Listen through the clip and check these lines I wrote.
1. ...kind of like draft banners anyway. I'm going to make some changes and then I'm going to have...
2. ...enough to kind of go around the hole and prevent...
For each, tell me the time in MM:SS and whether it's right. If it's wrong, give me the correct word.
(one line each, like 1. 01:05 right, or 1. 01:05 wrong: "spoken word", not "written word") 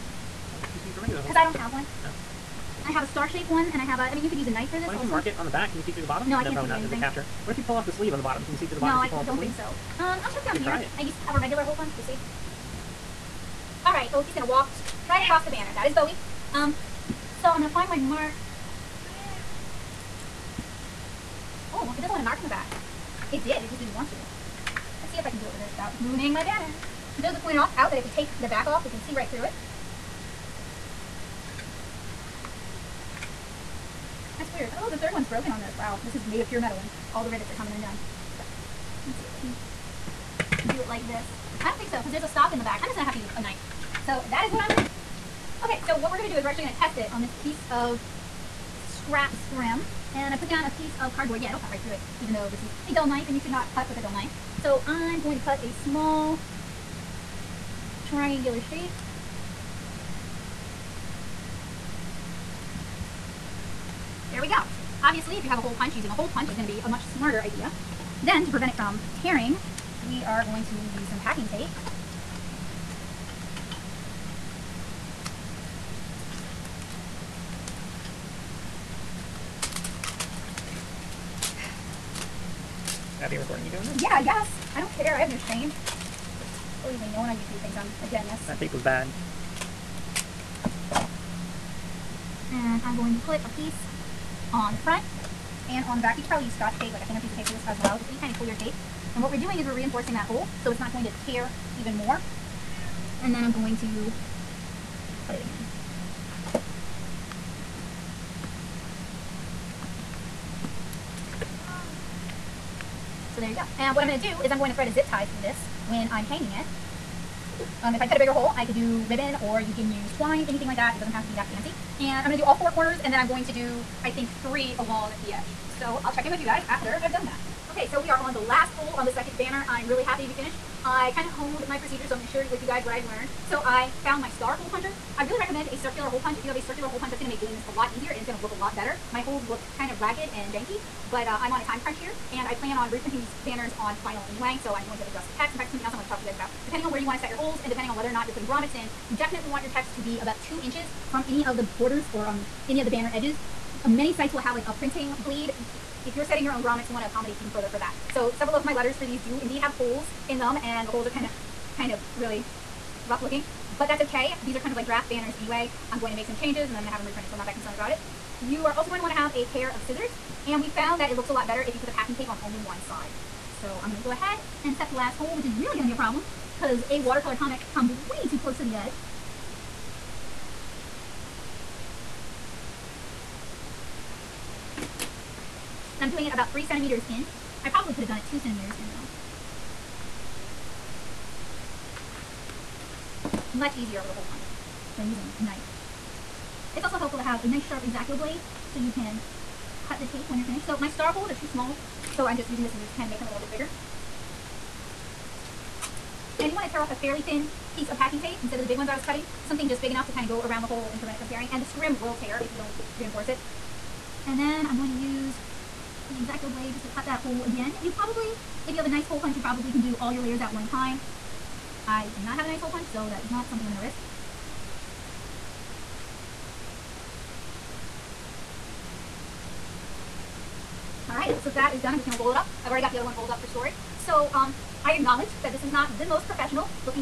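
1. 02:44 right
2. 03:29 right.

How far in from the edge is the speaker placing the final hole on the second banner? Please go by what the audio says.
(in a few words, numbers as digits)
3 centimeters.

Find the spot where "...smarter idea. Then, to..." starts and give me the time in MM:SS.
01:07.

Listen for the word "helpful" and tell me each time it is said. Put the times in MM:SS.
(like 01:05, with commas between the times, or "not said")
03:16.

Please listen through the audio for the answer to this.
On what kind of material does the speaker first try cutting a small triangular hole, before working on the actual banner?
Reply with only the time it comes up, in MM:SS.
00:48.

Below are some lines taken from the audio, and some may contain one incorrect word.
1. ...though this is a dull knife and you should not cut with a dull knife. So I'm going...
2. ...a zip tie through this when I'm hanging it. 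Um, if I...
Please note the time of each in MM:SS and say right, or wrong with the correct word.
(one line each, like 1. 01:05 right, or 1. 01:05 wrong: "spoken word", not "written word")
1. 00:52 right
2. 01:54 right.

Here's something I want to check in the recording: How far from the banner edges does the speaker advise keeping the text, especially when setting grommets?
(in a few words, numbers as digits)
2 inches.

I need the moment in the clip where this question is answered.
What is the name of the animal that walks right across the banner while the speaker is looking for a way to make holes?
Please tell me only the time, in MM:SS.
00:15.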